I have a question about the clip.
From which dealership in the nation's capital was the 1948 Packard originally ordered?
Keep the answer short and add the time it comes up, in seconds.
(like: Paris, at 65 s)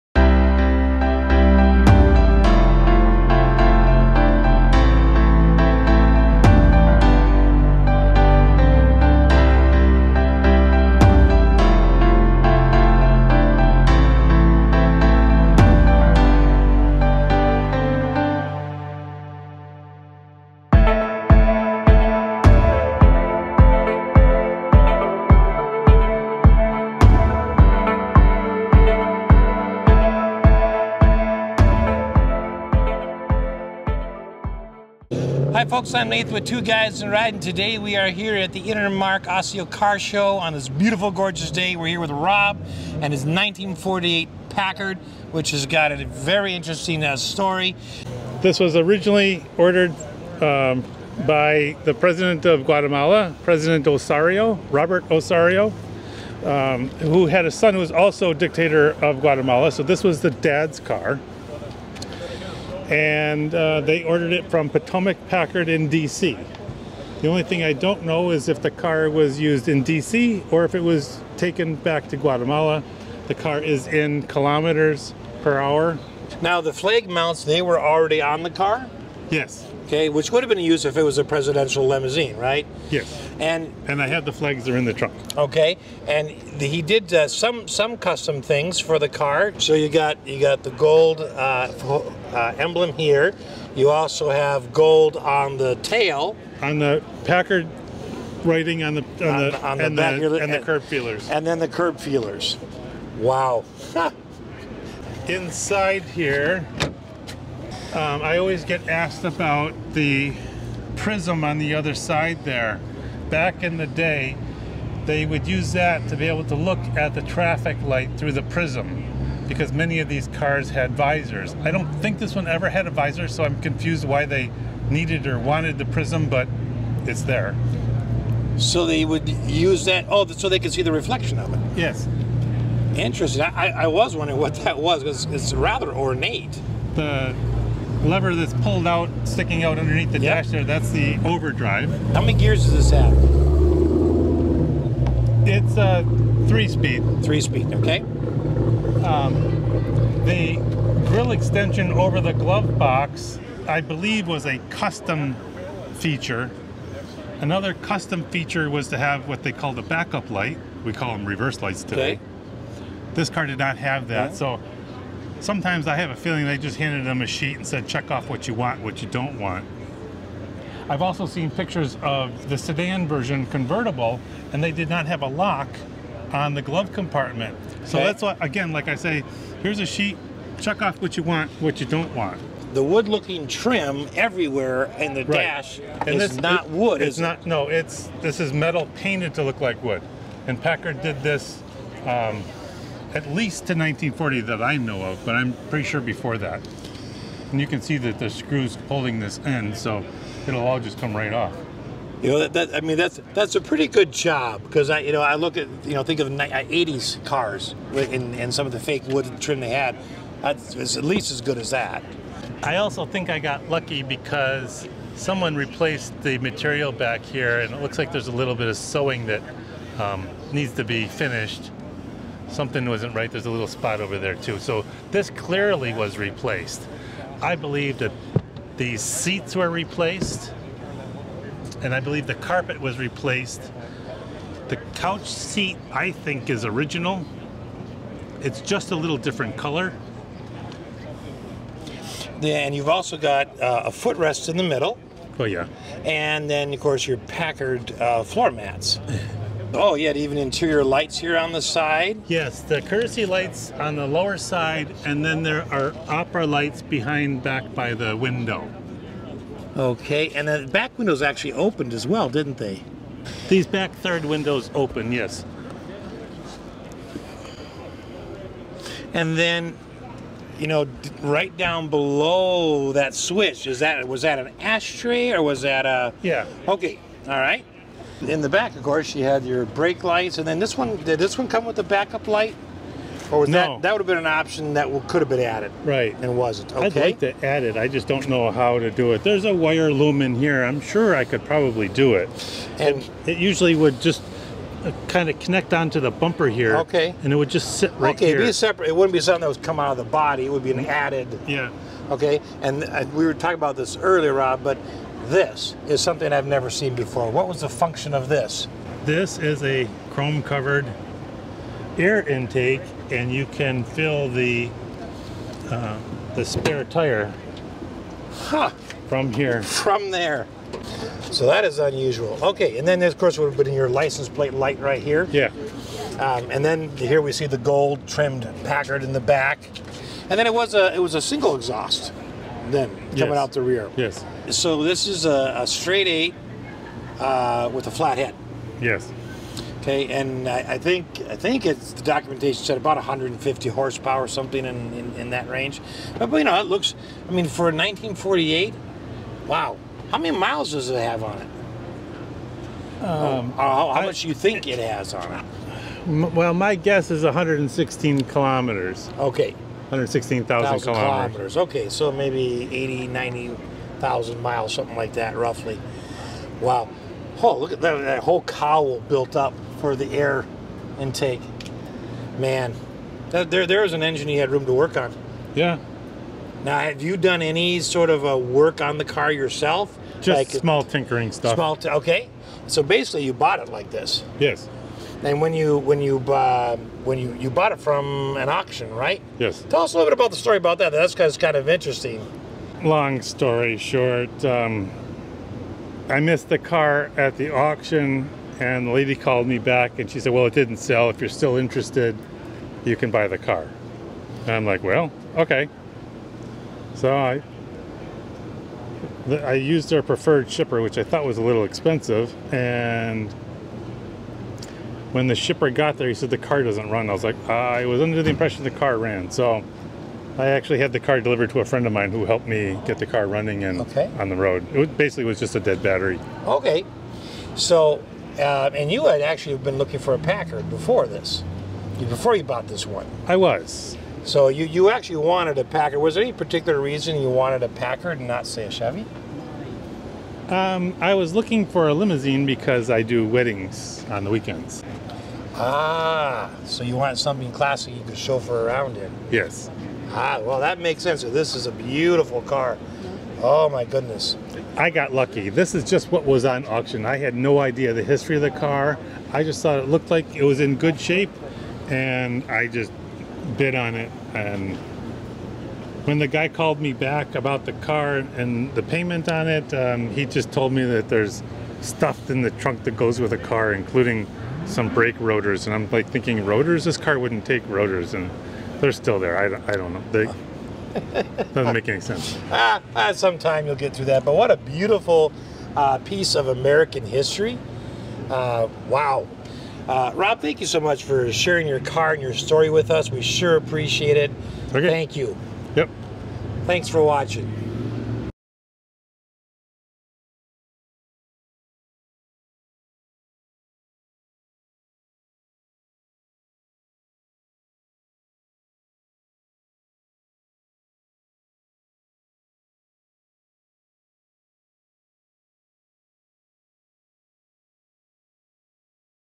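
Potomac Packard, at 64 s.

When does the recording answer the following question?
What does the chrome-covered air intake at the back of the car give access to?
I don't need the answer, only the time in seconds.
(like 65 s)
316 s.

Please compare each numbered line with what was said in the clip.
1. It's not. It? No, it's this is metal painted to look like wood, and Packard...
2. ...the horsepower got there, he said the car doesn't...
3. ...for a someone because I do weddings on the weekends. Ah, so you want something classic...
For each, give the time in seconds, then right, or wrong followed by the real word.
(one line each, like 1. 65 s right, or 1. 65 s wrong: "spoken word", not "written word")
1. 187 s right
2. 415 s wrong: "shipper", not "horsepower"
3. 441 s wrong: "limousine", not "someone".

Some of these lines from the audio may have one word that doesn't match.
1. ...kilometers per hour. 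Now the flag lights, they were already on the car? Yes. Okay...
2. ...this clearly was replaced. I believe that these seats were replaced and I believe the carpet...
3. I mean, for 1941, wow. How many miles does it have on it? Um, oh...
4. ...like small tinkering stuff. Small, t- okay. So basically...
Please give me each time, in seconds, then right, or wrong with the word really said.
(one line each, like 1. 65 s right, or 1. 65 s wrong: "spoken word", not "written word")
1. 74 s wrong: "mounts", not "lights"
2. 225 s right
3. 347 s wrong: "1948", not "1941"
4. 380 s right.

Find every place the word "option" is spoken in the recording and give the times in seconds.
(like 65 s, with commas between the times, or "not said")
284 s.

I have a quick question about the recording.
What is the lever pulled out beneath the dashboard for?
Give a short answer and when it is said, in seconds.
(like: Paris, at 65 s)
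overdrive, at 141 s.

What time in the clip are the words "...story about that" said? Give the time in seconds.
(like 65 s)
390 s.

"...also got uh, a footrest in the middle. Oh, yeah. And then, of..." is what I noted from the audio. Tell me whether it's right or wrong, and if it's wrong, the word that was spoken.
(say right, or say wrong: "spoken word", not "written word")
right.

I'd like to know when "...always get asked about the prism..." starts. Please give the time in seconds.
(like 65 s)
108 s.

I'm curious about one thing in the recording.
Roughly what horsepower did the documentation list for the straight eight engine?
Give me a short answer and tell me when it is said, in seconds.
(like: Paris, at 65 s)
150, at 342 s.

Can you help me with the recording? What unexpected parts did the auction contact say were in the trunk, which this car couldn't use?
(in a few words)
brake rotors.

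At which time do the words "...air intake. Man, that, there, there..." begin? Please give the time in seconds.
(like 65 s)
370 s.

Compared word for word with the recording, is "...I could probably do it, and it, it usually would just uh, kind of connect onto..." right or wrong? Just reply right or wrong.
right.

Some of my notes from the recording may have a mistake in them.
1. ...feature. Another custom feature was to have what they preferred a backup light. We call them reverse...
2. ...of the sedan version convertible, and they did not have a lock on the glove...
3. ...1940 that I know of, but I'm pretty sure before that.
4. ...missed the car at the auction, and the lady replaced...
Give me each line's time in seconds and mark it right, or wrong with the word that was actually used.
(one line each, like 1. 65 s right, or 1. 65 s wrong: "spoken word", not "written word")
1. 155 s wrong: "called", not "preferred"
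2. 172 s right
3. 193 s right
4. 396 s wrong: "called", not "replaced".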